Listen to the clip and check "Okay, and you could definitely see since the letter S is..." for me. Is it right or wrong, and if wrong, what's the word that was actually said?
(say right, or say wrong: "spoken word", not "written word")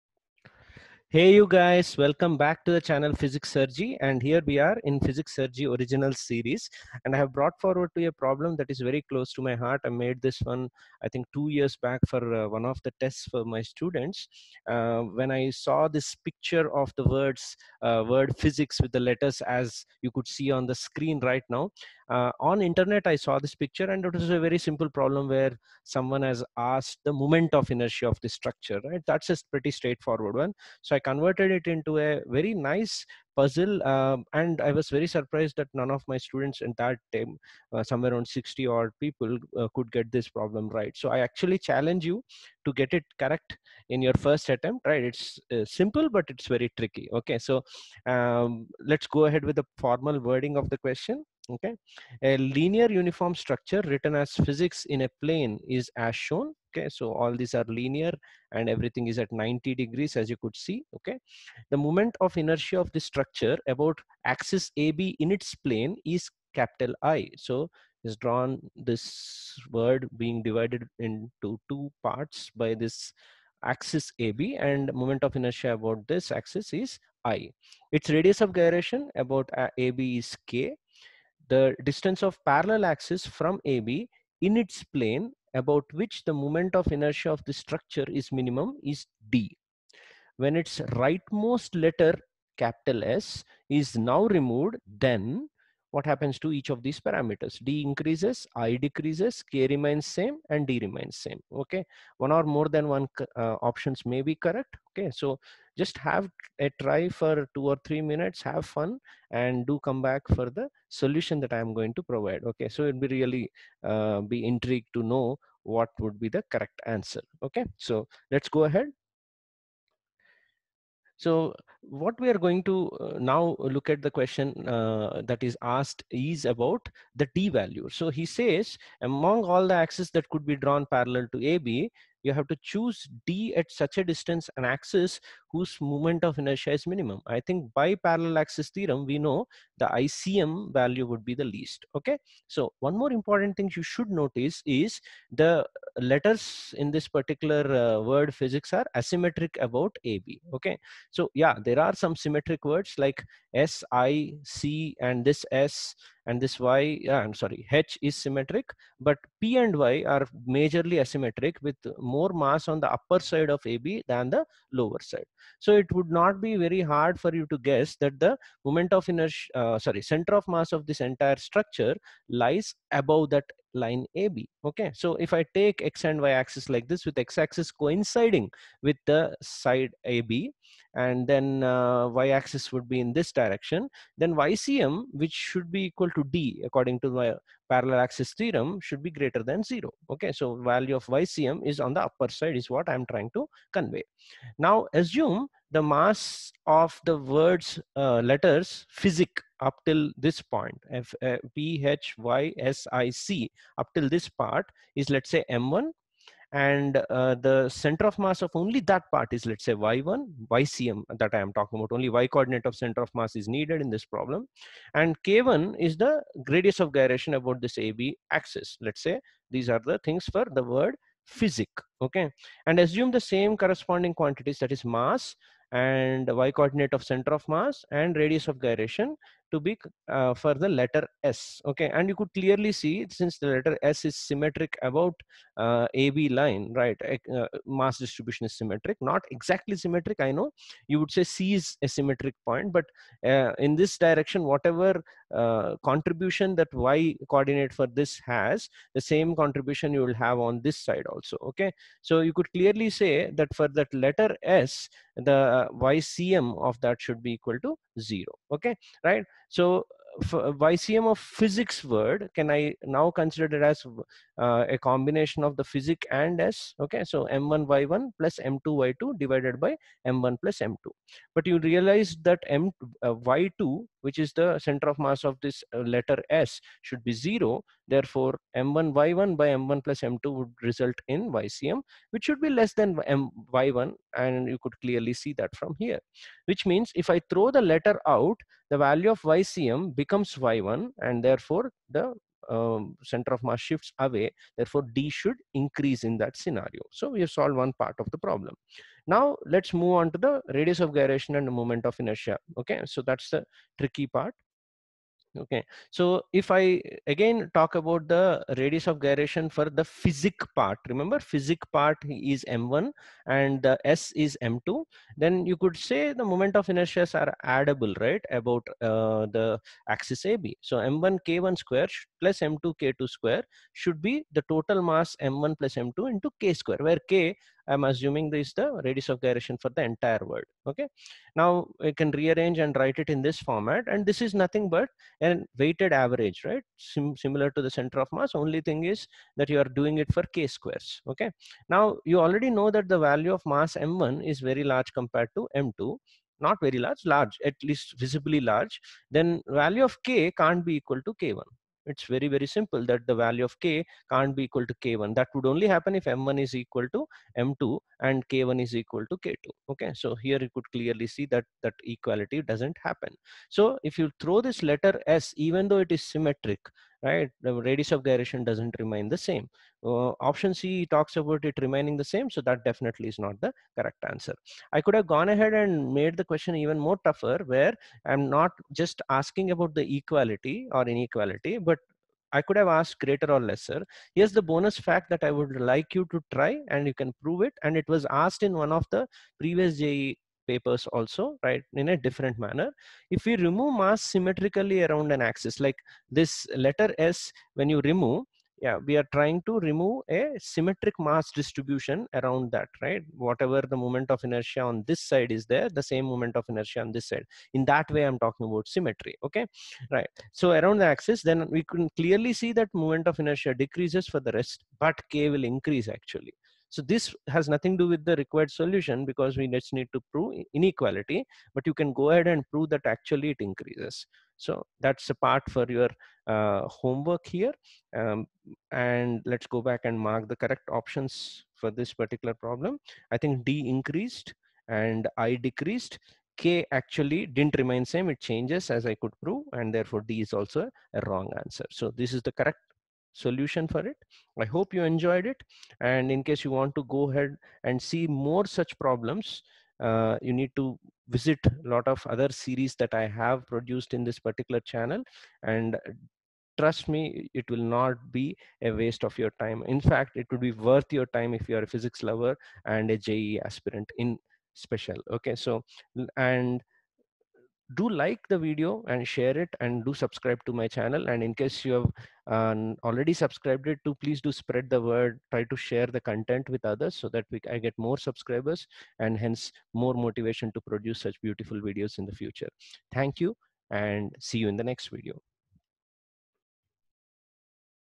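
wrong: "clearly", not "definitely".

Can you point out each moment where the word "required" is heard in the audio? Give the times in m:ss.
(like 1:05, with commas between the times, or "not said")
6:58.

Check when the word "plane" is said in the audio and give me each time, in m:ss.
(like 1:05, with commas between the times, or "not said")
0:55, 1:05, 1:24.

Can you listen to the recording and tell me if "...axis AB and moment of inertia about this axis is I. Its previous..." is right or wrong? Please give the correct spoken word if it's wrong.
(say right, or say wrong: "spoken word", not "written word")
wrong: "radius", not "previous".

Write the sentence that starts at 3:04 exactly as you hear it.
Then YCM, which should be equal to D according to the parallel axis theorem, should be greater than zero.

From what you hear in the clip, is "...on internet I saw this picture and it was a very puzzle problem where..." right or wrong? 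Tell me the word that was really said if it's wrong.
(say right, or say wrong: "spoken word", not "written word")
wrong: "simple", not "puzzle".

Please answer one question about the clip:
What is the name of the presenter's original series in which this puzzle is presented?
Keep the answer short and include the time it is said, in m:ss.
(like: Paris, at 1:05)
Physics Sir JEE original series, at 0:05.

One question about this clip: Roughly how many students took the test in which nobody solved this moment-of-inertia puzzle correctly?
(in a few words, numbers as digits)
60.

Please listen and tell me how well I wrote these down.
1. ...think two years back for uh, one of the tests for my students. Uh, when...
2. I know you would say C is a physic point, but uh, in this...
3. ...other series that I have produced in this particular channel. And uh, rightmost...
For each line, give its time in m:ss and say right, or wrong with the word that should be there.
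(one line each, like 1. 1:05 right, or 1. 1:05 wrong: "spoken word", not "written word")
1. 0:11 right
2. 4:00 wrong: "symmetric", not "physic"
3. 7:32 wrong: "trust", not "rightmost".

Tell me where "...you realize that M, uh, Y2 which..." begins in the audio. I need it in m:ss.
4:31.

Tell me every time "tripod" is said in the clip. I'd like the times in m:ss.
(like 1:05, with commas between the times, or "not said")
not said.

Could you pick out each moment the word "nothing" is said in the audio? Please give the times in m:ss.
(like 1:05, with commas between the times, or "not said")
5:34, 6:57.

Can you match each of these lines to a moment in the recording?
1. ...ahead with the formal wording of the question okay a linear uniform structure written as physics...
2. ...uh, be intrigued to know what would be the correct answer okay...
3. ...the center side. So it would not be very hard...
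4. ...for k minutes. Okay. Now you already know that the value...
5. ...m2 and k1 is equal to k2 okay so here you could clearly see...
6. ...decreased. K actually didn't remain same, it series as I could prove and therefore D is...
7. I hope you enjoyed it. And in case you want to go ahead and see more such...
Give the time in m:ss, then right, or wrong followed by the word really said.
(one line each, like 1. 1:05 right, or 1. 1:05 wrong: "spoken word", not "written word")
1. 0:49 right
2. 1:53 right
3. 2:44 wrong: "lower", not "center"
4. 5:40 wrong: "squares", not "minutes"
5. 5:57 right
6. 7:15 wrong: "changes", not "series"
7. 7:24 right.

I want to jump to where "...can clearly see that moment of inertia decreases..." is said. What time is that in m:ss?
6:51.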